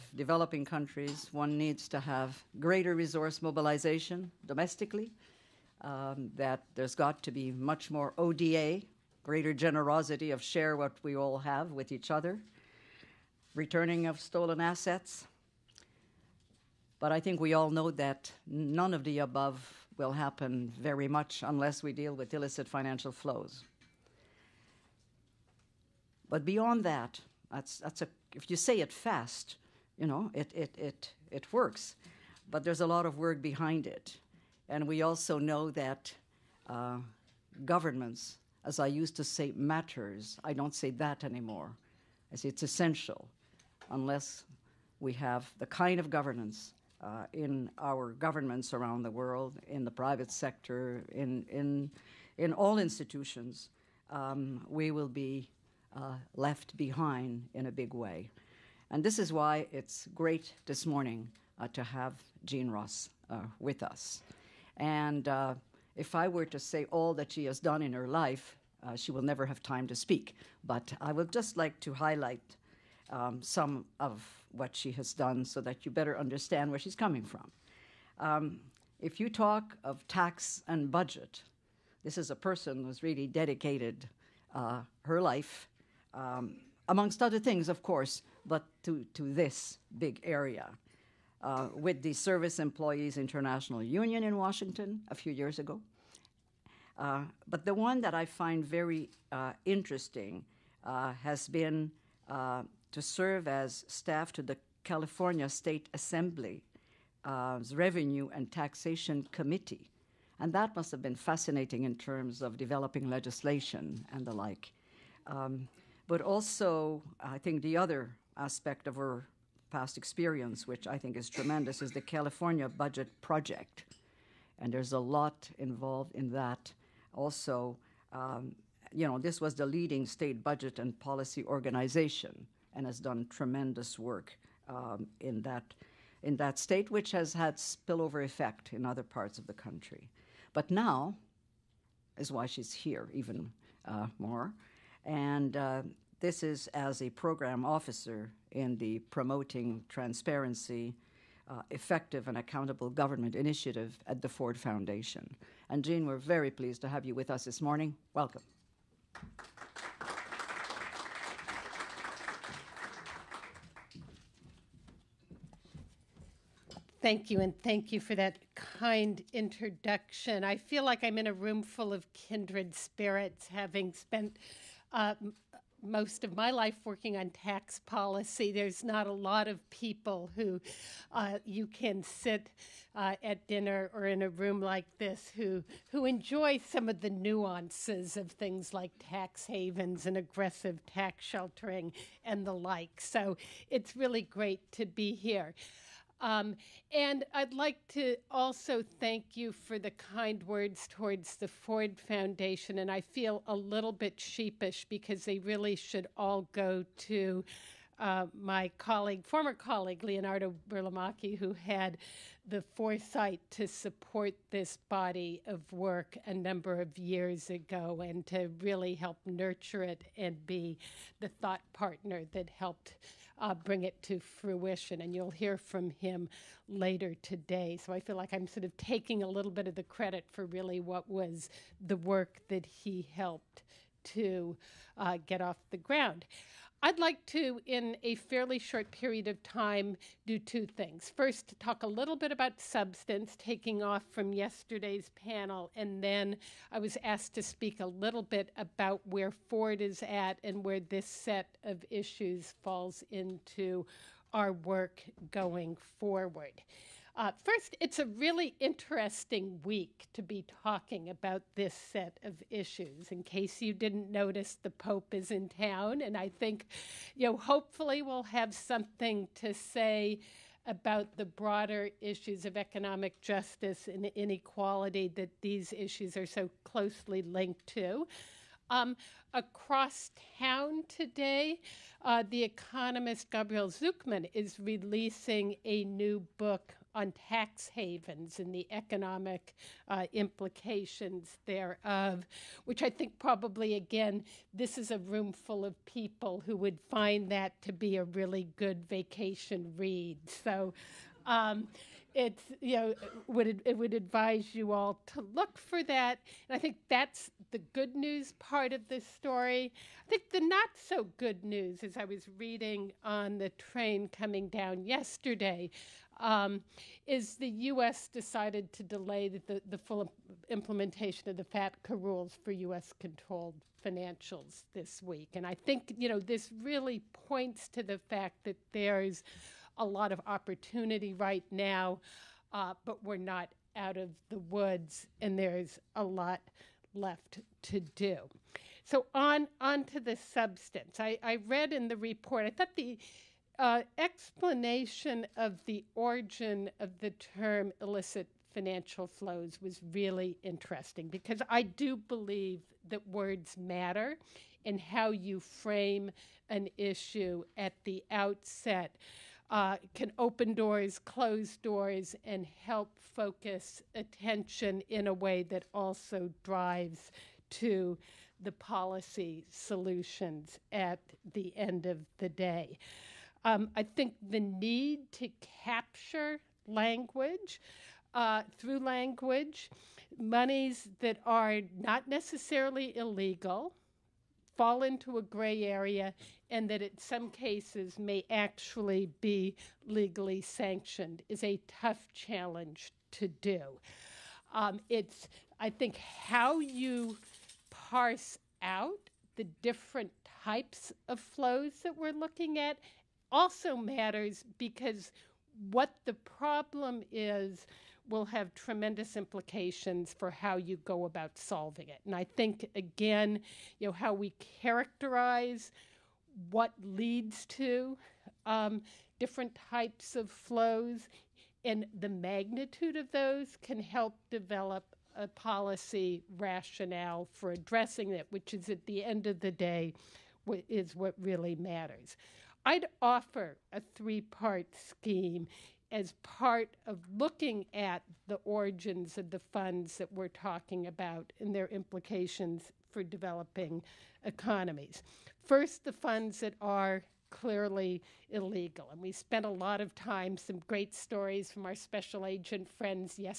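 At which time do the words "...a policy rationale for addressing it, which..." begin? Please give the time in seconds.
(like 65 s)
425 s.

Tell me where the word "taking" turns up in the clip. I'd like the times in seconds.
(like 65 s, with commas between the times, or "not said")
228 s, 243 s.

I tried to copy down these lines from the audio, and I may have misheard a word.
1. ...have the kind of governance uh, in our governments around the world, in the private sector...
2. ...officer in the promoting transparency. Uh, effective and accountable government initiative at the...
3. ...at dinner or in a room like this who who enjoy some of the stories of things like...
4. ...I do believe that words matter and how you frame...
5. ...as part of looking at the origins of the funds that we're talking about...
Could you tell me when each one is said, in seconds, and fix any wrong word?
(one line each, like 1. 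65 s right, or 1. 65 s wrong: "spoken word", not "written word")
1. 45 s right
2. 147 s right
3. 183 s wrong: "nuances", not "stories"
4. 351 s right
5. 435 s right.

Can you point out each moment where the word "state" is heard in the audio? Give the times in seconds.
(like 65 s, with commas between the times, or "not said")
105 s, 130 s, 136 s.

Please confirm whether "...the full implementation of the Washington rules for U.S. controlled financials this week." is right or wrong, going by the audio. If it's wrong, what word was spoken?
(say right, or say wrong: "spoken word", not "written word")
wrong: "FATCA", not "Washington".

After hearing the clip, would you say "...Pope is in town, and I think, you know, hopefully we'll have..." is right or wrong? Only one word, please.
right.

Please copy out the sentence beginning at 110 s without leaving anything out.
And that must have been fascinating in terms of developing legislation and the like.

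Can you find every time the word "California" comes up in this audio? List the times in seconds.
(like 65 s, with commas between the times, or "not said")
104 s, 122 s.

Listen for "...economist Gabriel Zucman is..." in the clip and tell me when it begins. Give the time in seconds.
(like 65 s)
282 s.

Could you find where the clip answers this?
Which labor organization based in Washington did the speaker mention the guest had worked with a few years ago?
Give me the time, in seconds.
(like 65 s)
92 s.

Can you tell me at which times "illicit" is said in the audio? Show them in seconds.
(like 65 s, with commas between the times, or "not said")
22 s, 347 s.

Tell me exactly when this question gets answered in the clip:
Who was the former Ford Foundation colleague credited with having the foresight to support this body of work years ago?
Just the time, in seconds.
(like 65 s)
210 s.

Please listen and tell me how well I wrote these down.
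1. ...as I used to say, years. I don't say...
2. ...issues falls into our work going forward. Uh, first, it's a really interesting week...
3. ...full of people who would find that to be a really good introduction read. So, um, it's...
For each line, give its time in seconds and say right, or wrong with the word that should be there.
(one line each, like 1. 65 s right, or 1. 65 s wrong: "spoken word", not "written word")
1. 38 s wrong: "matters", not "years"
2. 251 s right
3. 295 s wrong: "vacation", not "introduction".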